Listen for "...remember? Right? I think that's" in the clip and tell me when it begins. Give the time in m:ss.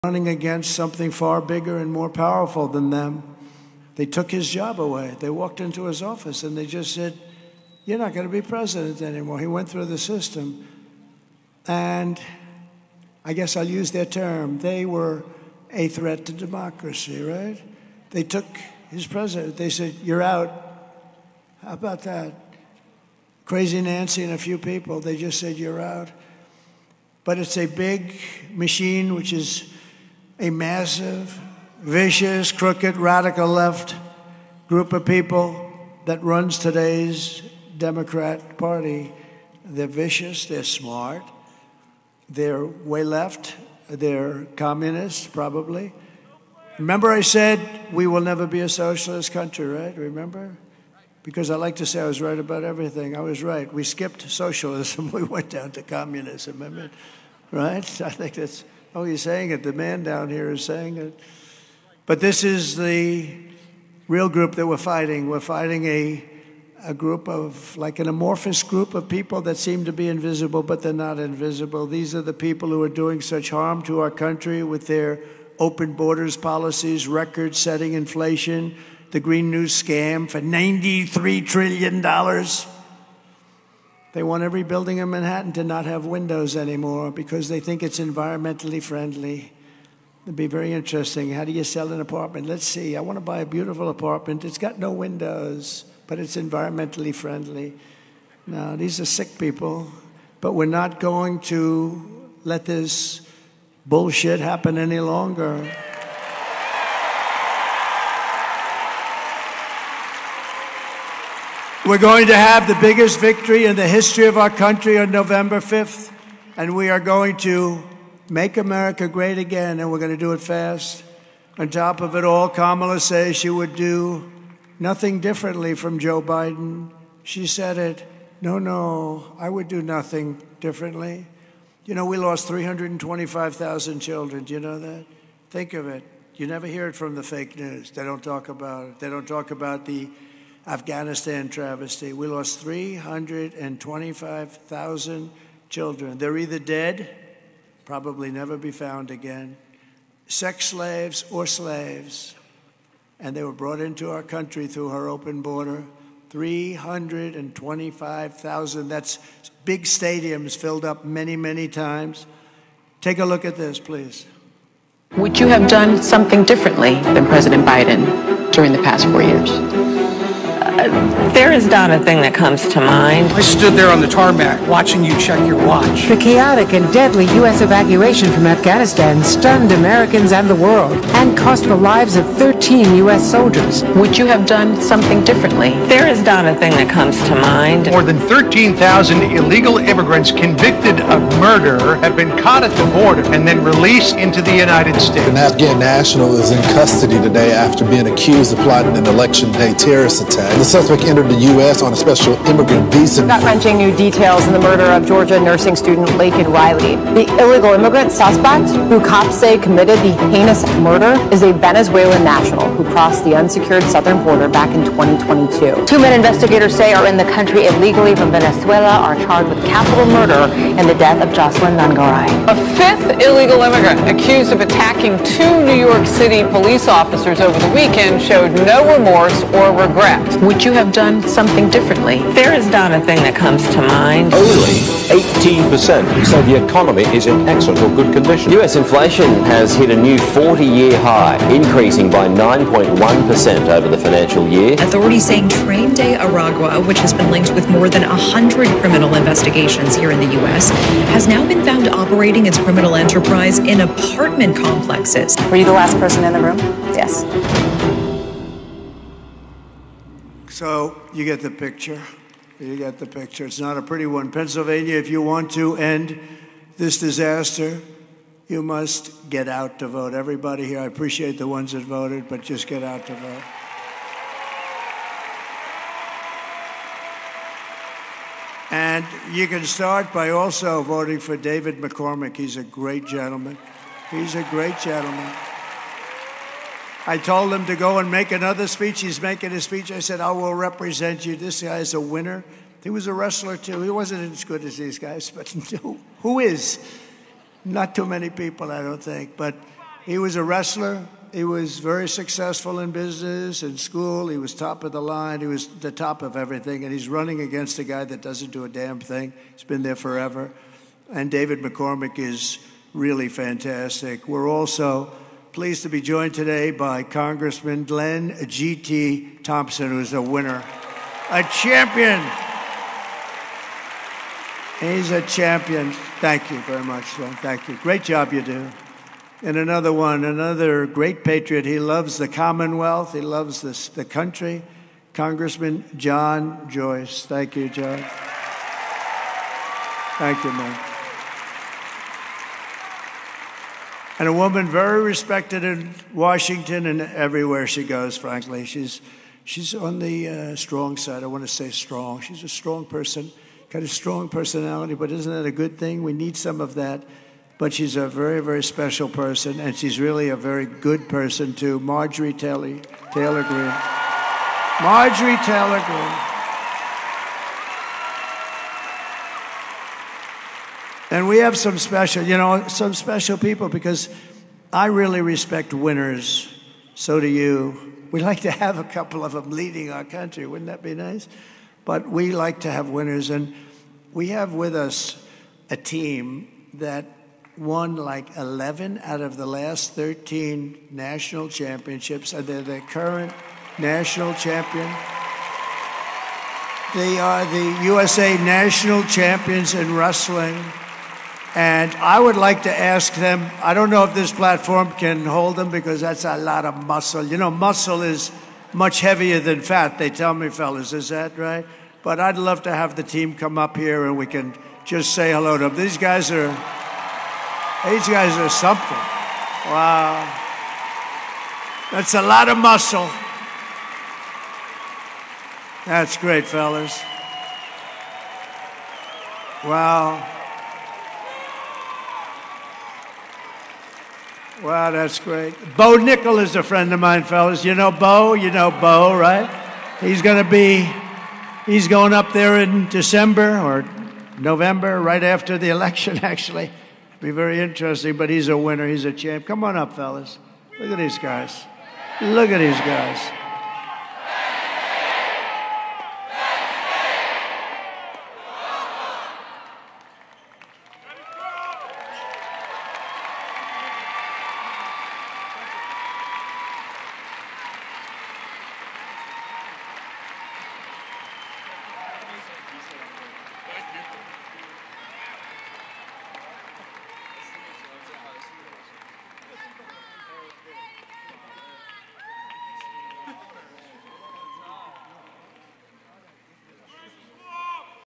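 0:56.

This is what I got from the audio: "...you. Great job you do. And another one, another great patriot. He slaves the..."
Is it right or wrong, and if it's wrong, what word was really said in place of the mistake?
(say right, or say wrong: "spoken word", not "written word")
wrong: "loves", not "slaves".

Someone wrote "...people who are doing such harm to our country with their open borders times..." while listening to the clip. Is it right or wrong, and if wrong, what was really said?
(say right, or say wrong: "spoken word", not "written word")
wrong: "policies", not "times".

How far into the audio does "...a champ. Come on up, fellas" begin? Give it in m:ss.
7:29.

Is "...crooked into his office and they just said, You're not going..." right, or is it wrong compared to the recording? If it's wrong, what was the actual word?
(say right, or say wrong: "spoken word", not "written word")
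wrong: "walked", not "crooked".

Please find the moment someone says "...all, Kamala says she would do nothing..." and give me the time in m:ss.
2:02.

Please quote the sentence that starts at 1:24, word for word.
They want every building in Manhattan to not have windows anymore because they think it's environmentally friendly.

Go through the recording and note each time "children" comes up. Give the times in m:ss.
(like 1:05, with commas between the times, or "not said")
2:13, 2:25.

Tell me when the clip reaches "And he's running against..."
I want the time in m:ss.
5:06.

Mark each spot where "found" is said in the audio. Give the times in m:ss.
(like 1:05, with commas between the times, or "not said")
2:28, 4:11.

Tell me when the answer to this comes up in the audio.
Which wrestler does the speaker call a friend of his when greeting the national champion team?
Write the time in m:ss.
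7:15.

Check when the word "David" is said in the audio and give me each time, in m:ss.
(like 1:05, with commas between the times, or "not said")
4:41, 5:11.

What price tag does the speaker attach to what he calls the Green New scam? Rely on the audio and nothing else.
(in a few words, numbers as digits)
$93 trillion.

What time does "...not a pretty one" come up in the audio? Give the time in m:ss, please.
4:23.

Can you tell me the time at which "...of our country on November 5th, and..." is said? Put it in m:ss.
1:54.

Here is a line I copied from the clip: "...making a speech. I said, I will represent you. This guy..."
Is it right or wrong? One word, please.
right.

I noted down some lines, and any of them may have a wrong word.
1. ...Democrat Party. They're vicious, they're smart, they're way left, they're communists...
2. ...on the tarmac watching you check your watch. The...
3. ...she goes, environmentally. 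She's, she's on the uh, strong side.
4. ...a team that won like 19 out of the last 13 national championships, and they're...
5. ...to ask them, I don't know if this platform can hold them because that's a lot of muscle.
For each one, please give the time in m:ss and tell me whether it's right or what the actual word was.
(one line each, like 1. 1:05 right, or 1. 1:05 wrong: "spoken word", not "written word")
1. 0:37 right
2. 2:53 right
3. 5:47 wrong: "frankly", not "environmentally"
4. 6:25 wrong: "11", not "19"
5. 6:42 right.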